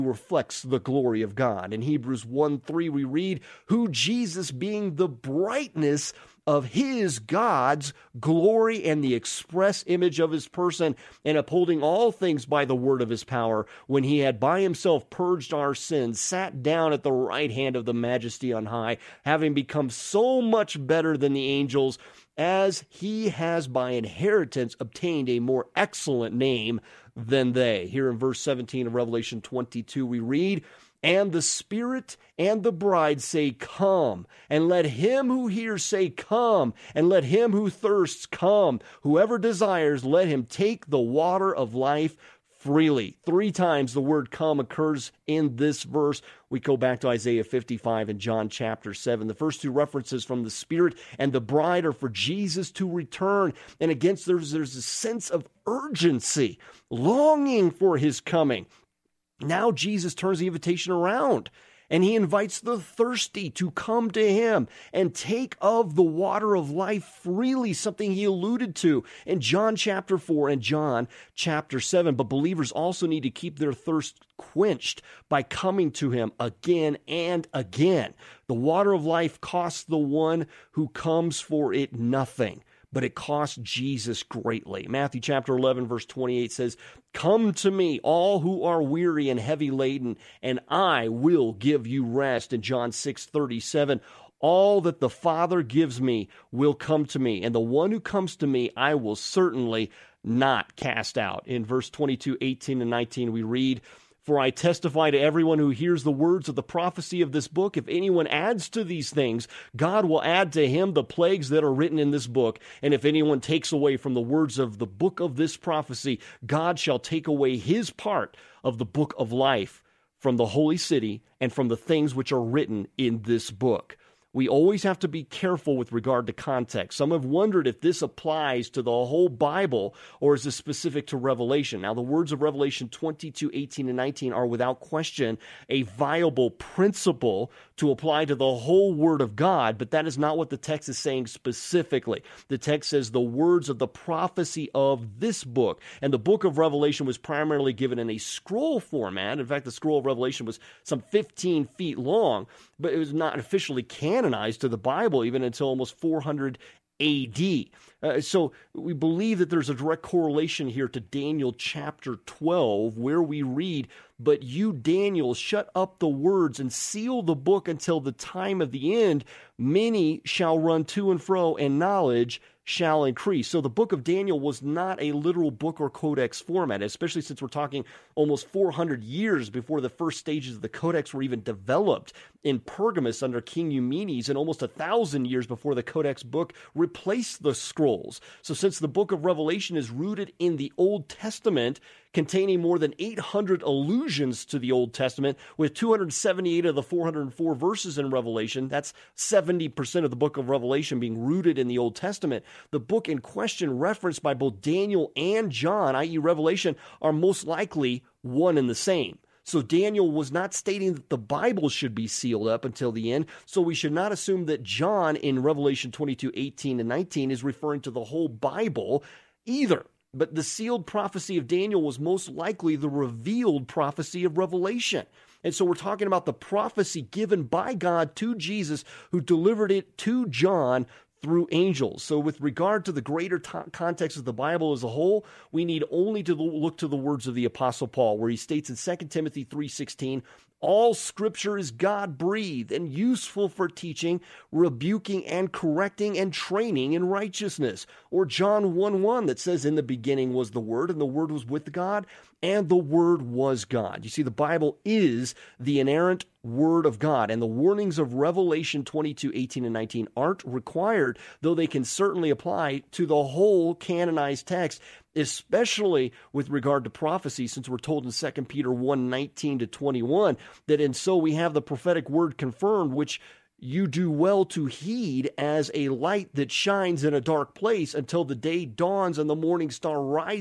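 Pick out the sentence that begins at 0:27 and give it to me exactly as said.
Here in verse 17 of Revelation 22, we read, and the Spirit and the bride say, Come.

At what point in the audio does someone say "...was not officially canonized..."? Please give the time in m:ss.
2:32.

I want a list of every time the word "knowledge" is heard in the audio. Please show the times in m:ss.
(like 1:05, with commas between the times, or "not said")
2:51.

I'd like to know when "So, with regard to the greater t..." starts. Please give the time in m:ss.
3:52.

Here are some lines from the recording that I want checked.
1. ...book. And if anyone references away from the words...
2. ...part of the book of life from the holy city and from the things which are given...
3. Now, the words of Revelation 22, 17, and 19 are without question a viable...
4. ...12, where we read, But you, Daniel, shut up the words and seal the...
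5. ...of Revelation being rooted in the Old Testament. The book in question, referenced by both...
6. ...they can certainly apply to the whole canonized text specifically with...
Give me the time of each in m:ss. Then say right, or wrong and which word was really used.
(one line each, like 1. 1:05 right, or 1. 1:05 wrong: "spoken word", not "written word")
1. 1:52 wrong: "takes", not "references"
2. 1:57 wrong: "written", not "given"
3. 2:11 wrong: "18", not "17"
4. 2:42 right
5. 3:20 right
6. 4:21 wrong: "especially", not "specifically".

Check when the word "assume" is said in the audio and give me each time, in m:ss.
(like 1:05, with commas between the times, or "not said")
3:34.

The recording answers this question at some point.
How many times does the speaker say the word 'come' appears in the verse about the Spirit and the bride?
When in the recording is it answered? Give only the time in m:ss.
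0:43.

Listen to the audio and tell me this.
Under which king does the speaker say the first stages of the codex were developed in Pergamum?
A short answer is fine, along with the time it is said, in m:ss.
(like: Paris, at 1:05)
King Eumenes, at 3:03.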